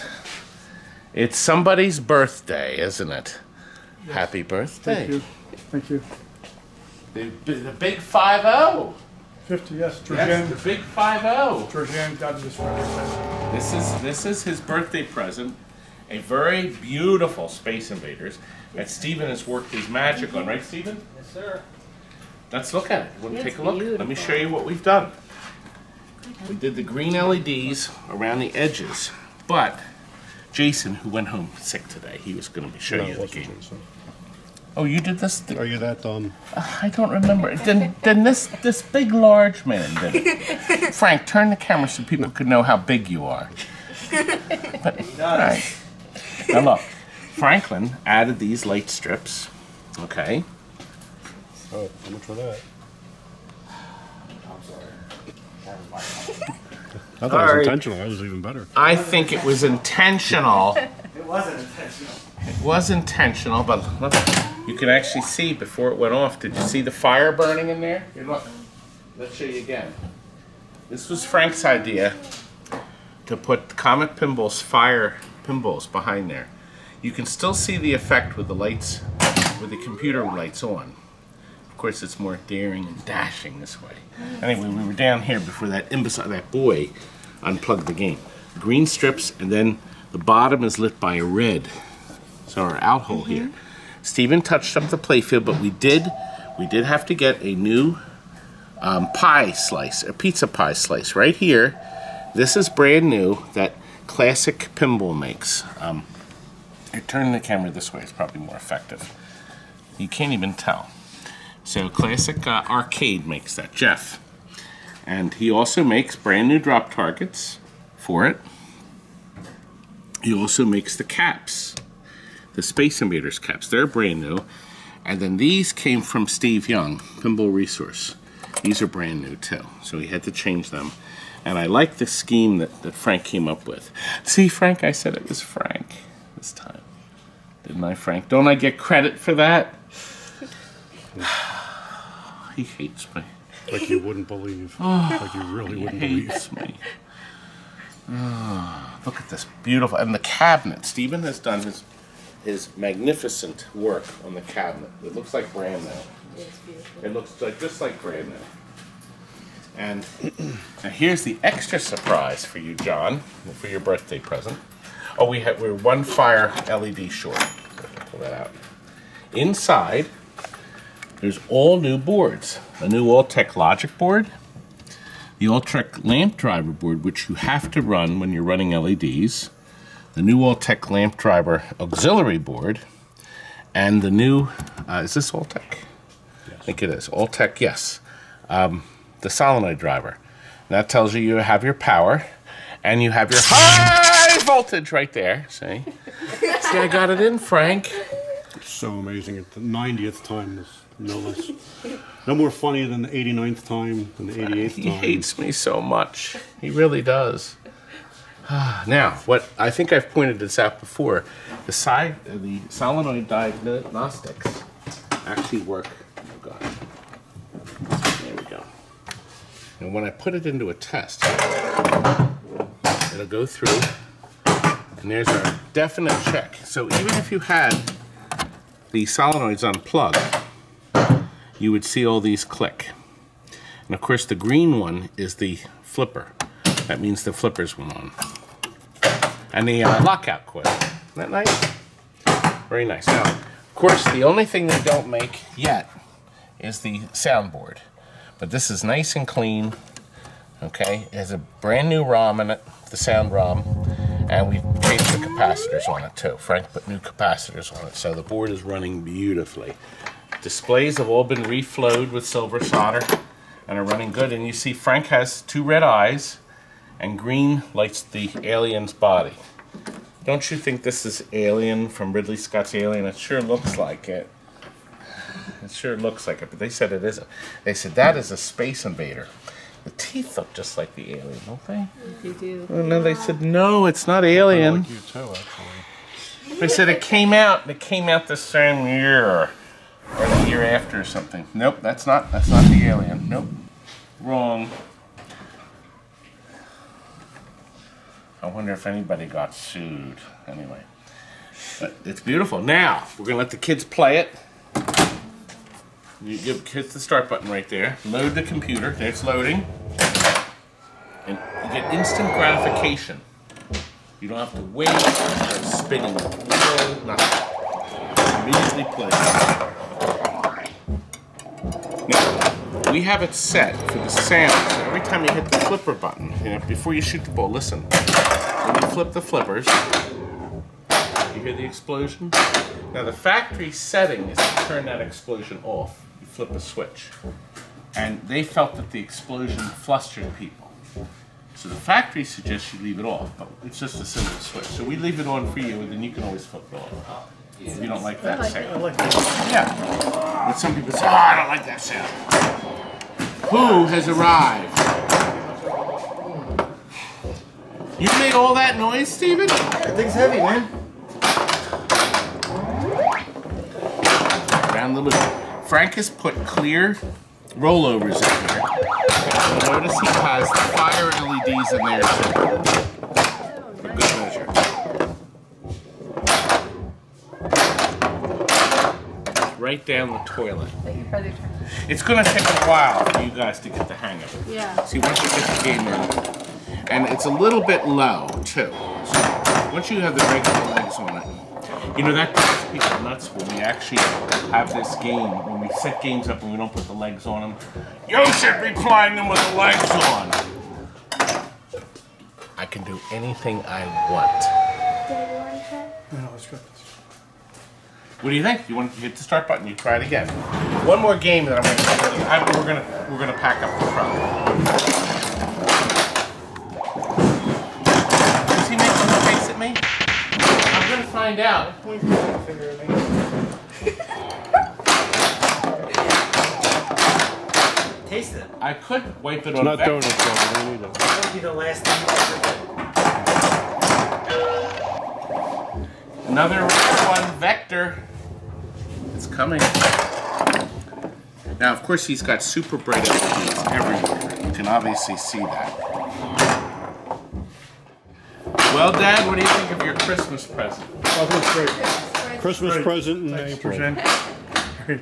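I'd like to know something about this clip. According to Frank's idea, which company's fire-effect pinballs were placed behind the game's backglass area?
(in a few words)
Comet Pinball.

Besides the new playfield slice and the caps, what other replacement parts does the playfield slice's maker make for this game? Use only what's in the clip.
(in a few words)
drop targets.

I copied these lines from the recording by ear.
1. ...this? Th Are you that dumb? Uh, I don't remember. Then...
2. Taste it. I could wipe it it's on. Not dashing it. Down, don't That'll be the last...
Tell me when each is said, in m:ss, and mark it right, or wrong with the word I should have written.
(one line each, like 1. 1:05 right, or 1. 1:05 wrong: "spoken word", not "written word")
1. 0:35 right
2. 7:08 wrong: "throwing", not "dashing".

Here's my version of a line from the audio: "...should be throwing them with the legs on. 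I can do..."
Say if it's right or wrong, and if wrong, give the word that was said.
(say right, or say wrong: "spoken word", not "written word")
wrong: "playing", not "throwing".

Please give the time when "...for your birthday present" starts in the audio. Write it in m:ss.
2:43.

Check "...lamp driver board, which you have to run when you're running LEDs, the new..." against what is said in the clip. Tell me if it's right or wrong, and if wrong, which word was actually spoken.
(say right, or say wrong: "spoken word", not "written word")
right.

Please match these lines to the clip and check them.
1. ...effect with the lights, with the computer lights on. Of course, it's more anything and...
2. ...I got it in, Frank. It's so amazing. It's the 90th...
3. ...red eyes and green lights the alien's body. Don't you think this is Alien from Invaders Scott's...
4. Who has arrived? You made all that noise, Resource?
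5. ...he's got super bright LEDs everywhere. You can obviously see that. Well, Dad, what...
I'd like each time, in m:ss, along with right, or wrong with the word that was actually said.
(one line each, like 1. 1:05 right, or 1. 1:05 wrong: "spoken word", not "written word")
1. 1:17 wrong: "daring", not "anything"
2. 3:16 right
3. 4:25 wrong: "Ridley", not "Invaders"
4. 5:53 wrong: "Steven", not "Resource"
5. 7:22 right.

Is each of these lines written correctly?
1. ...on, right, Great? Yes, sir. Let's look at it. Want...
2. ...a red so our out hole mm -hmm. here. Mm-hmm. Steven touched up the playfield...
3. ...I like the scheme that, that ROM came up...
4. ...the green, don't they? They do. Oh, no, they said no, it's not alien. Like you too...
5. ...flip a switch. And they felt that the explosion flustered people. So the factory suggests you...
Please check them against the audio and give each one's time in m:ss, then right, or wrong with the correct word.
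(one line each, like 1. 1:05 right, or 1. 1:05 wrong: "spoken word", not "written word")
1. 0:20 wrong: "Steven", not "Great"
2. 1:31 right
3. 2:11 wrong: "Frank", not "ROM"
4. 4:40 wrong: "alien", not "green"
5. 5:36 right.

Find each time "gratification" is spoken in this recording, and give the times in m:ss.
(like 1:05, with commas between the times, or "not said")
5:12.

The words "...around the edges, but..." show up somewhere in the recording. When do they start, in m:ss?
0:28.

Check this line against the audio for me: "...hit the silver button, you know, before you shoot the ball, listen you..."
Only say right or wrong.
wrong.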